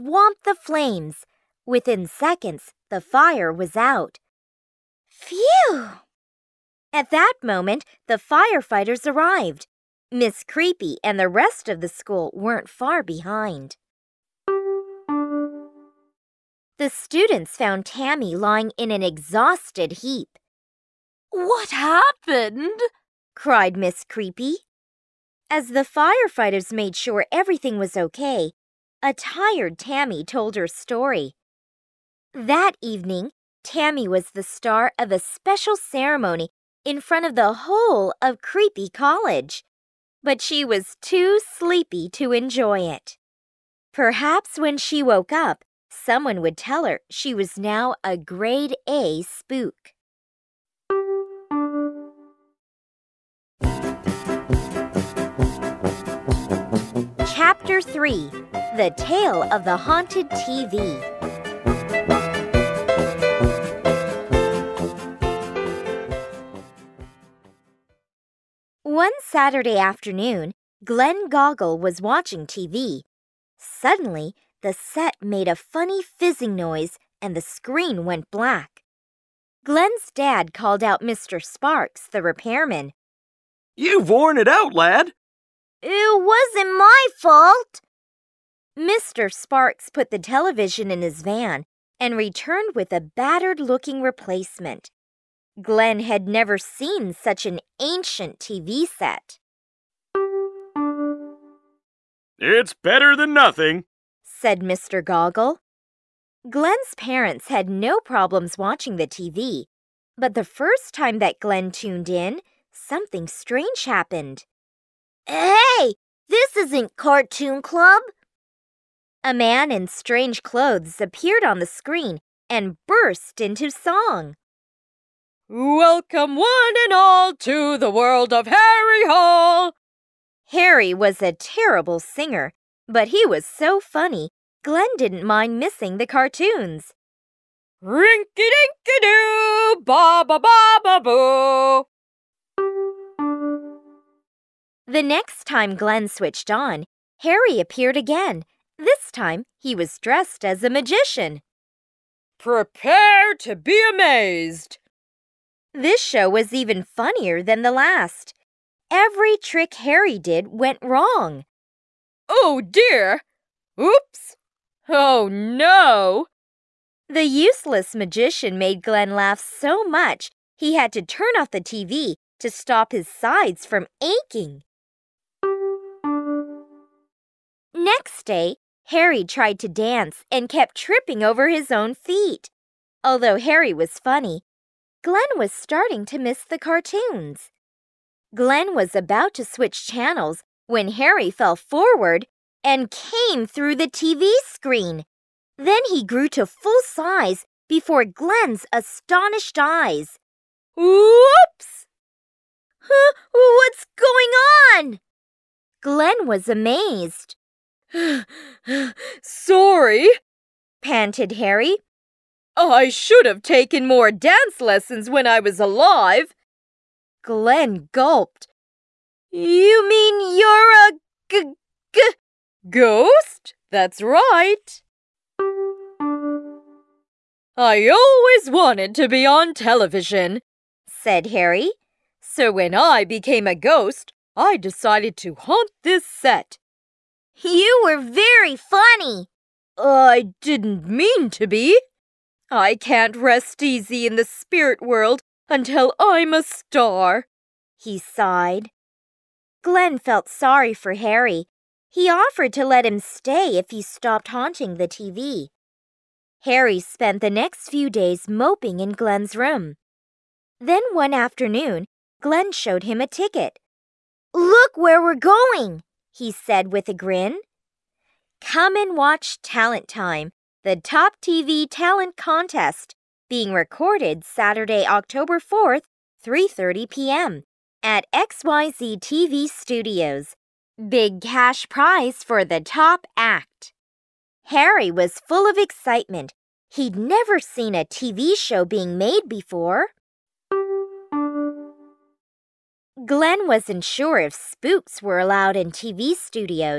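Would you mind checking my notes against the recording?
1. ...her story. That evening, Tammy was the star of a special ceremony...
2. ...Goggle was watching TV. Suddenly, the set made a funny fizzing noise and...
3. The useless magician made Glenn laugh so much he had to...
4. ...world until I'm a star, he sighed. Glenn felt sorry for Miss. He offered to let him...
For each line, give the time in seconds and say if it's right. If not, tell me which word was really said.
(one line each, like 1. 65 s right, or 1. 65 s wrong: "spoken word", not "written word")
1. 30 s right
2. 71 s right
3. 167 s right
4. 244 s wrong: "Harry", not "Miss".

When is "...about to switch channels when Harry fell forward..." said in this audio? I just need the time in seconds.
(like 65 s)
188 s.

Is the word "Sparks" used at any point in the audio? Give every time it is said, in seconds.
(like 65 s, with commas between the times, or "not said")
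81 s, 89 s.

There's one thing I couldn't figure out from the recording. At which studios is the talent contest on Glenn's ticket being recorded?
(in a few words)
XYZ TV Studios.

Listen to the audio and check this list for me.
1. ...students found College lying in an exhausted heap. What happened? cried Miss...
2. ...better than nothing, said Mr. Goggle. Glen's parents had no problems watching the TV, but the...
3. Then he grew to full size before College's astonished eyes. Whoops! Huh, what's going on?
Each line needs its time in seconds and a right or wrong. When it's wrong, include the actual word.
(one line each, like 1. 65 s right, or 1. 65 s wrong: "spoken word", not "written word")
1. 16 s wrong: "Tammy", not "College"
2. 102 s right
3. 195 s wrong: "Glen", not "College".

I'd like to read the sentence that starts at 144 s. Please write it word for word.
The next time Glenn switched on, Harry appeared again.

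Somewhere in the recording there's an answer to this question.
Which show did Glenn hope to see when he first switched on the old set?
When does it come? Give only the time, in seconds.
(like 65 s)
116 s.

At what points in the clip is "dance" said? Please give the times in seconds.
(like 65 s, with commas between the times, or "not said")
179 s, 214 s.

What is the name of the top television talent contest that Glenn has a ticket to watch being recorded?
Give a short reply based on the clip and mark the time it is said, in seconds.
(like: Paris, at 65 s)
Talent Time, at 269 s.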